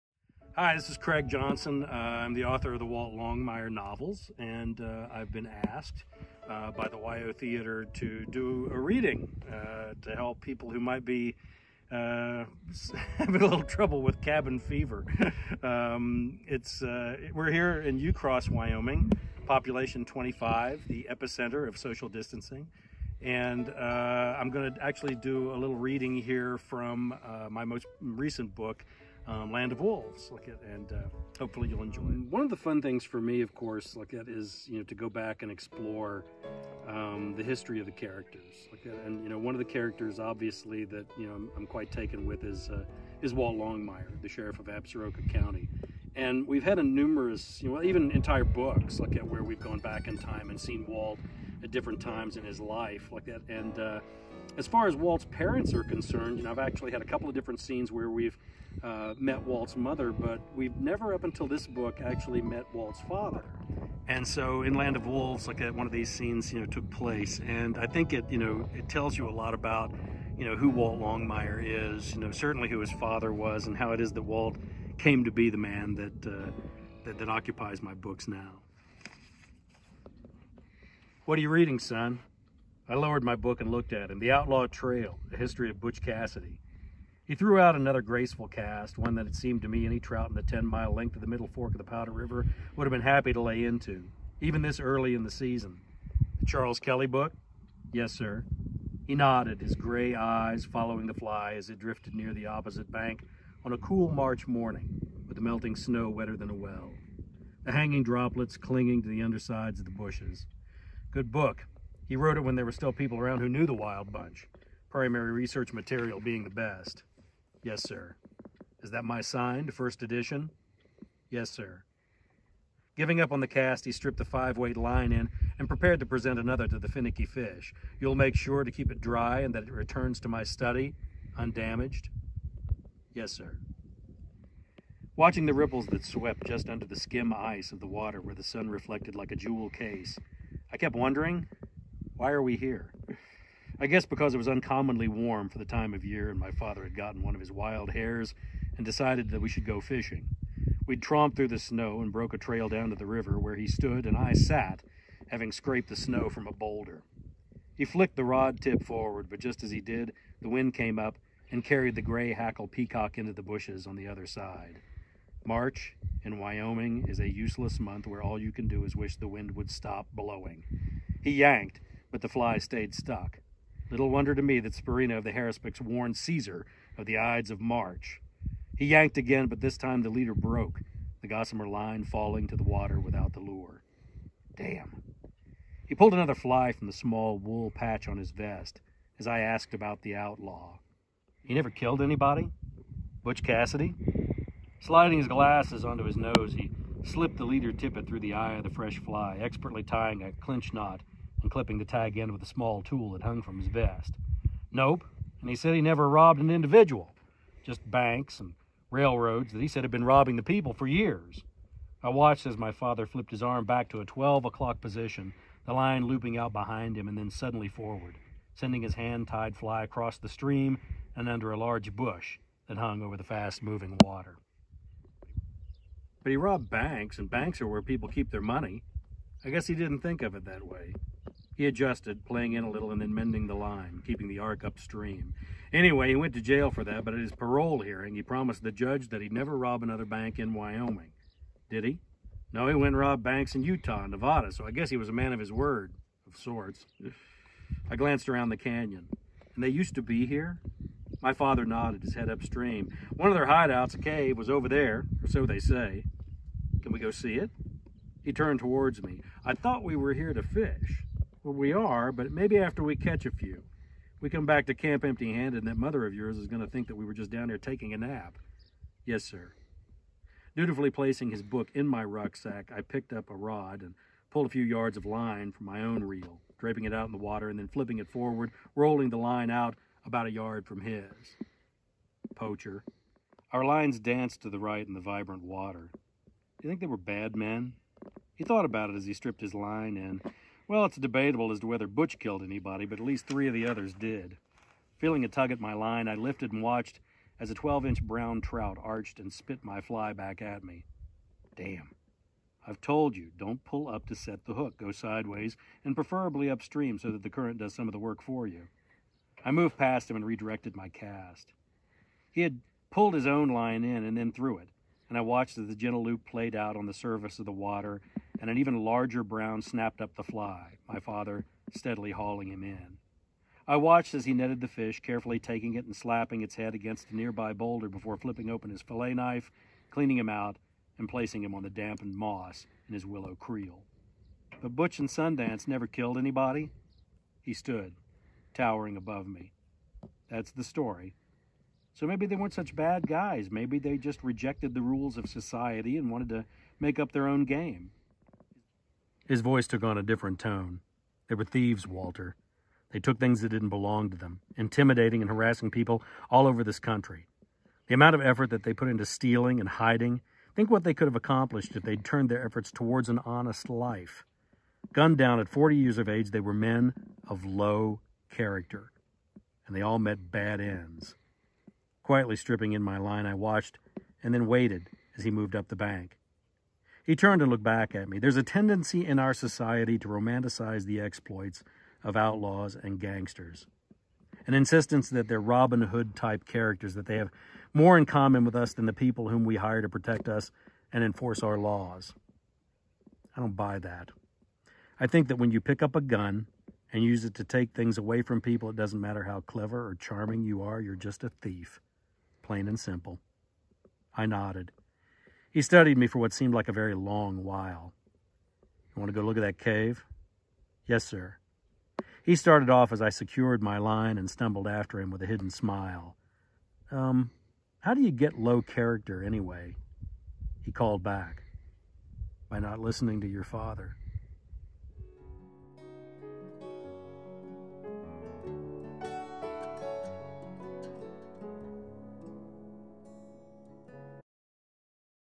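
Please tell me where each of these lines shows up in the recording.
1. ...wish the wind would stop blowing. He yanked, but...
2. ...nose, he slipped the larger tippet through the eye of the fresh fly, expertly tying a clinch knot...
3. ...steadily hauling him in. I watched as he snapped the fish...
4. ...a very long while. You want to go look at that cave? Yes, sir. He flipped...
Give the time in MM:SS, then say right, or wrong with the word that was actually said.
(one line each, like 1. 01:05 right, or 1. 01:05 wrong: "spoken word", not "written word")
1. 02:48 right
2. 03:16 wrong: "leader", not "larger"
3. 05:21 wrong: "netted", not "snapped"
4. 06:46 wrong: "started", not "flipped".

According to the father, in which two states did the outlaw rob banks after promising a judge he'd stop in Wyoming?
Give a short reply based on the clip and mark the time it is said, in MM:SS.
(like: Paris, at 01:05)
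Utah and Nevada, at 04:03.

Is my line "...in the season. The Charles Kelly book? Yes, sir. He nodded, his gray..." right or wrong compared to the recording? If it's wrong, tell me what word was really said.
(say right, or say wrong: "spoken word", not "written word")
right.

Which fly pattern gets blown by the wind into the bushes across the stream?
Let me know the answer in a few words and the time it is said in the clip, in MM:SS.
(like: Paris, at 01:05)
gray hackle peacock, at 02:42.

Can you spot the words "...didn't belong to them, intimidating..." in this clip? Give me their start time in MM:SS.
05:53.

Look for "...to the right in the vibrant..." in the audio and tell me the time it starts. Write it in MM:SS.
04:44.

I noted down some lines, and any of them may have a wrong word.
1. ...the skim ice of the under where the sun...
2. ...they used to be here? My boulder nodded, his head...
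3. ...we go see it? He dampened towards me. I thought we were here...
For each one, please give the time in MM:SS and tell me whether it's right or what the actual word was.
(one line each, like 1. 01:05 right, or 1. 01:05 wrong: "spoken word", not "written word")
1. 02:16 wrong: "water", not "under"
2. 04:09 wrong: "father", not "boulder"
3. 04:16 wrong: "turned", not "dampened".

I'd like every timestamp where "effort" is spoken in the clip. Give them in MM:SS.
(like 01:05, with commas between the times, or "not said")
05:58, 06:02.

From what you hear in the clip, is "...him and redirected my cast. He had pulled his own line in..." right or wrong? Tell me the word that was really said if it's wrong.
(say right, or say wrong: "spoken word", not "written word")
right.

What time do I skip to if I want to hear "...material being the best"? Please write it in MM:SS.
01:55.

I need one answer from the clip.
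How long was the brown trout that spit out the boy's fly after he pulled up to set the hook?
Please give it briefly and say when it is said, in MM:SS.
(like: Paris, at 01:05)
12 inches, at 04:57.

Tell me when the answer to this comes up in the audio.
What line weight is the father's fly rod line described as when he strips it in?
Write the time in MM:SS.
02:04.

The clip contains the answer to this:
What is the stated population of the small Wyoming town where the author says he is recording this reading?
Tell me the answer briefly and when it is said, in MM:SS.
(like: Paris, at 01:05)
25, at 00:19.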